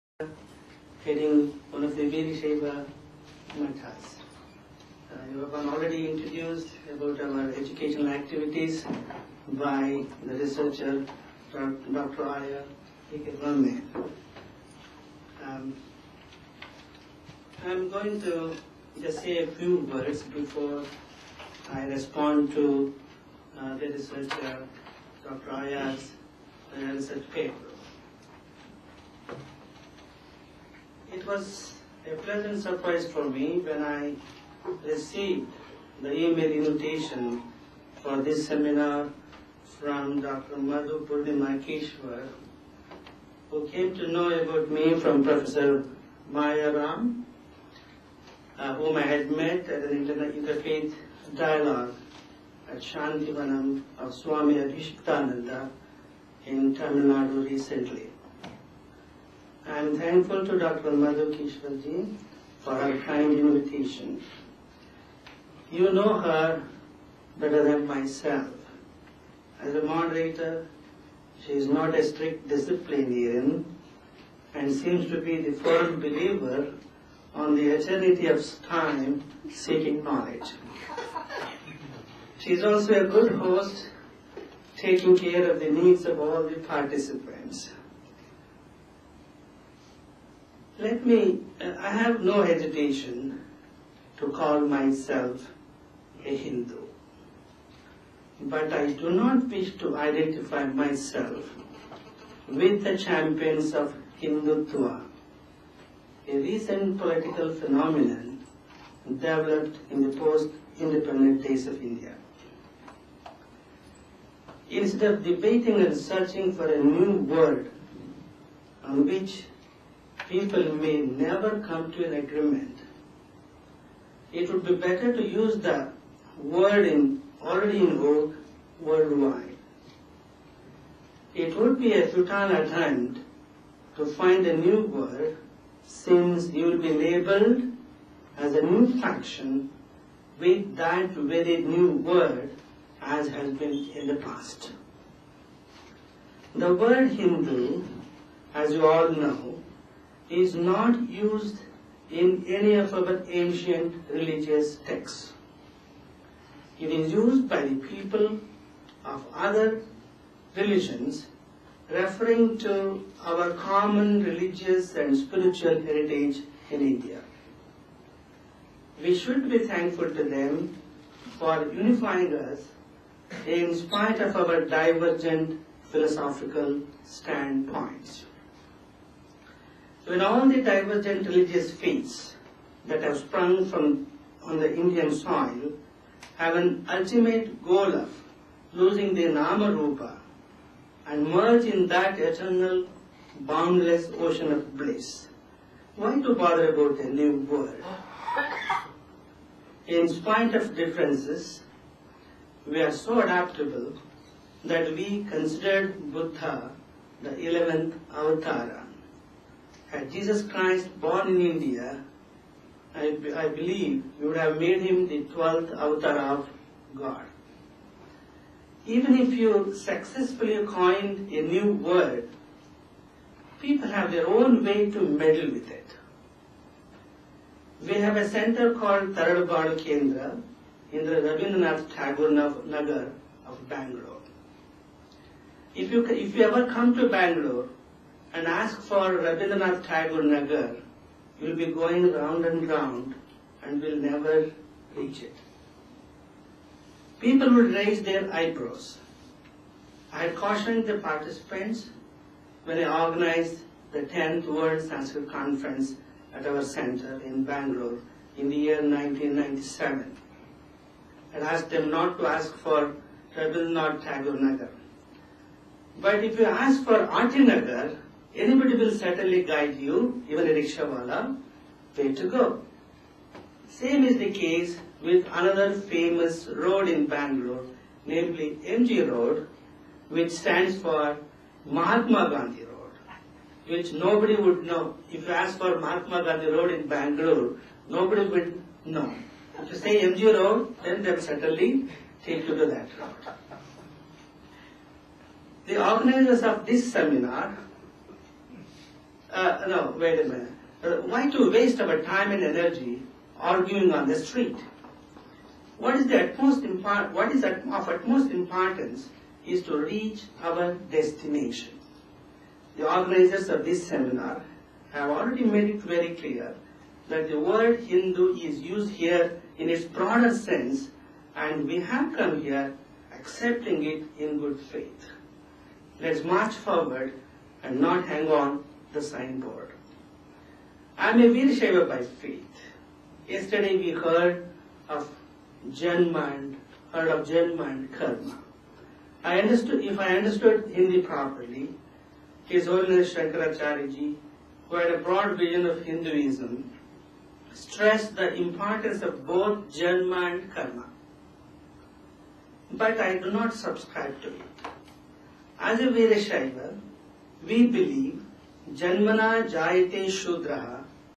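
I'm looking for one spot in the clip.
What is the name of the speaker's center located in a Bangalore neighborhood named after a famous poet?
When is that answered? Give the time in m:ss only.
3:49.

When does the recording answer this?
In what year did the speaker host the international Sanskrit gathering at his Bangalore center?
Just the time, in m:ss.
4:18.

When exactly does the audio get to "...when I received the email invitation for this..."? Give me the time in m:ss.
0:33.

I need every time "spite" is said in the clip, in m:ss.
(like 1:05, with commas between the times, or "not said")
2:53, 3:20.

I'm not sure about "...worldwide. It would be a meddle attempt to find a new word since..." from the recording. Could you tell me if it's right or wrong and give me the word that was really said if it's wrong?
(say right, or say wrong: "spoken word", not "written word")
wrong: "futile", not "meddle".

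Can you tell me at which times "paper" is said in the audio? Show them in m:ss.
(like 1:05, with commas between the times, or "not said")
0:27.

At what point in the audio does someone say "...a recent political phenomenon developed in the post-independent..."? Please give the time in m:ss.
1:46.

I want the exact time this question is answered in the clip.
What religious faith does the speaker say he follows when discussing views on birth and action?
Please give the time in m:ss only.
5:31.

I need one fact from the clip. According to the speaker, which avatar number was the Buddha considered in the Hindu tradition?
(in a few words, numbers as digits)
11th.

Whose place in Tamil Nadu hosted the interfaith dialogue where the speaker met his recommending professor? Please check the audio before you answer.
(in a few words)
Swami Adhishtananda.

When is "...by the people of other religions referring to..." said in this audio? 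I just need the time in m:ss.
2:37.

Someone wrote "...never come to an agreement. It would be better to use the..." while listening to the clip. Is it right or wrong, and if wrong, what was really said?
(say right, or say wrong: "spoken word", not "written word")
right.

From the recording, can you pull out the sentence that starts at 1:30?
Let me, uh, I have no hesitation to call myself a Hindu.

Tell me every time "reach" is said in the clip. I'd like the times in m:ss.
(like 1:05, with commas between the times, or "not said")
4:04, 5:09.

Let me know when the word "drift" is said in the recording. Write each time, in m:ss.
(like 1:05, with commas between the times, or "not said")
not said.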